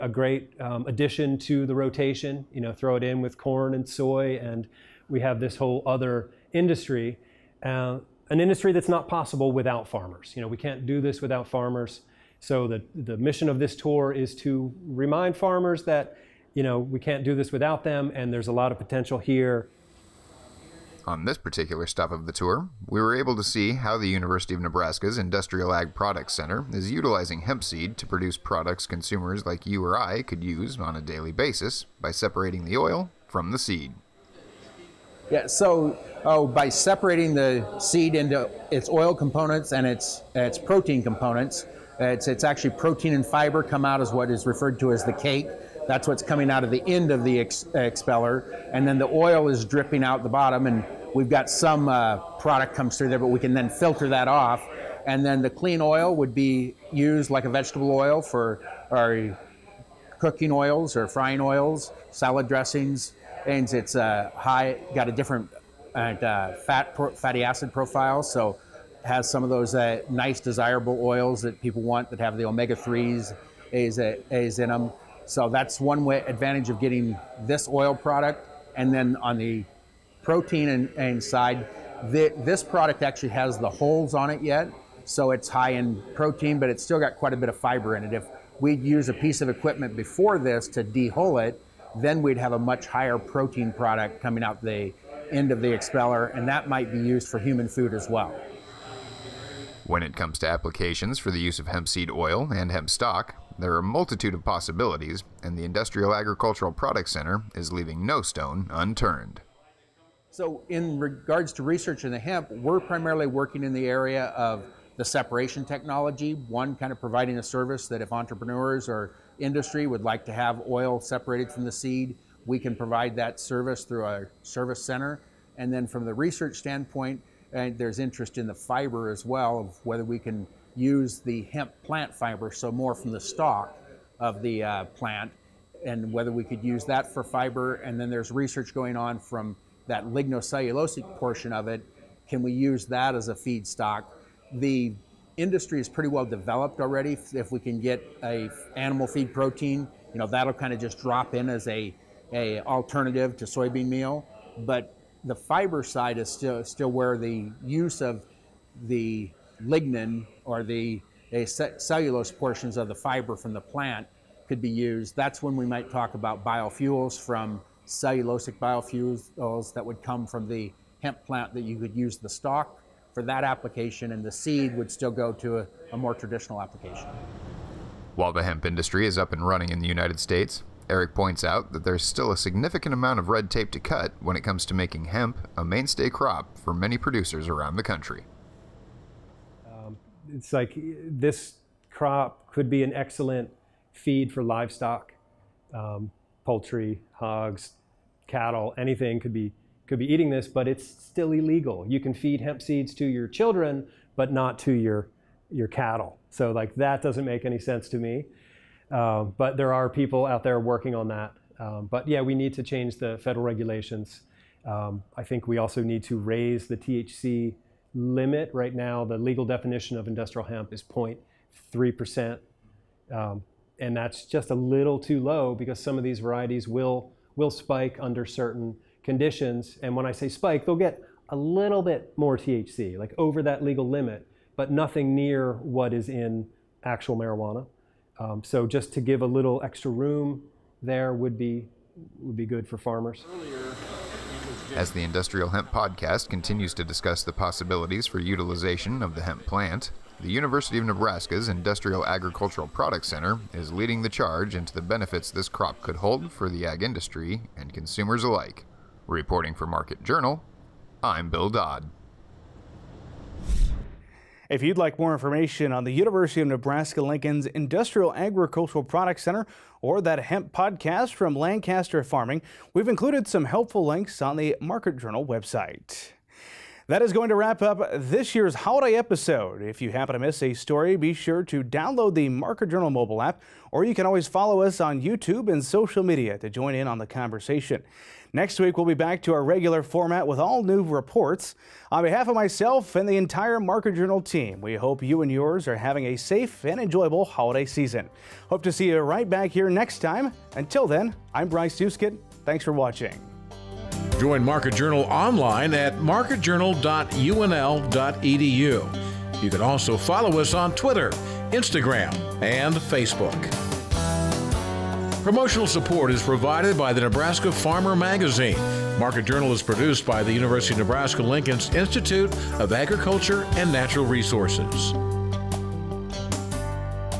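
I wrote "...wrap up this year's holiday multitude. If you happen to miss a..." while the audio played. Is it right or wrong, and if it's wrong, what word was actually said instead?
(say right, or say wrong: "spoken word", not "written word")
wrong: "episode", not "multitude".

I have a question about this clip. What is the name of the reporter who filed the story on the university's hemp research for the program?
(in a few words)
Bill Dodd.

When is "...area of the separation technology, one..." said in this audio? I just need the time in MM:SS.
01:53.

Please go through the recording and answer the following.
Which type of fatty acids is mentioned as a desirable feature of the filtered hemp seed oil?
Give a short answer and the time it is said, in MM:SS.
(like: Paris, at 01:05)
omega-3s, at 01:12.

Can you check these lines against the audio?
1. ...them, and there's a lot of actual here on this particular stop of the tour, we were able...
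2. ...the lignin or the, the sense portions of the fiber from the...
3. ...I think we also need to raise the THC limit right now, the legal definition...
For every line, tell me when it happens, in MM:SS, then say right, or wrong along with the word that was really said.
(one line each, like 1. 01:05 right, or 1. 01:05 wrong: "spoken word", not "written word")
1. 00:17 wrong: "potential", not "actual"
2. 02:38 wrong: "cellulose", not "sense"
3. 03:35 right.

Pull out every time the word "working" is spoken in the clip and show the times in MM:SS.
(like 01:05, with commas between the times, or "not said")
01:53, 03:30.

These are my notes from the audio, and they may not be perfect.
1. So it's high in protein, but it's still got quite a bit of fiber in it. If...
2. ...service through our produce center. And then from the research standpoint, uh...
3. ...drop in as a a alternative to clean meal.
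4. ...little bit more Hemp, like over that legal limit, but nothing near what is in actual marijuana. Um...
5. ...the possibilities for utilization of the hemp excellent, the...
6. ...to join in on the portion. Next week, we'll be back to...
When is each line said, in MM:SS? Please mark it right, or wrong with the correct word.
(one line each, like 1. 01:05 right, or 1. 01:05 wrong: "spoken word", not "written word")
1. 01:25 right
2. 02:03 wrong: "service", not "produce"
3. 02:30 wrong: "soybean", not "clean"
4. 03:51 wrong: "THC", not "Hemp"
5. 04:07 wrong: "plant", not "excellent"
6. 04:46 wrong: "conversation", not "portion".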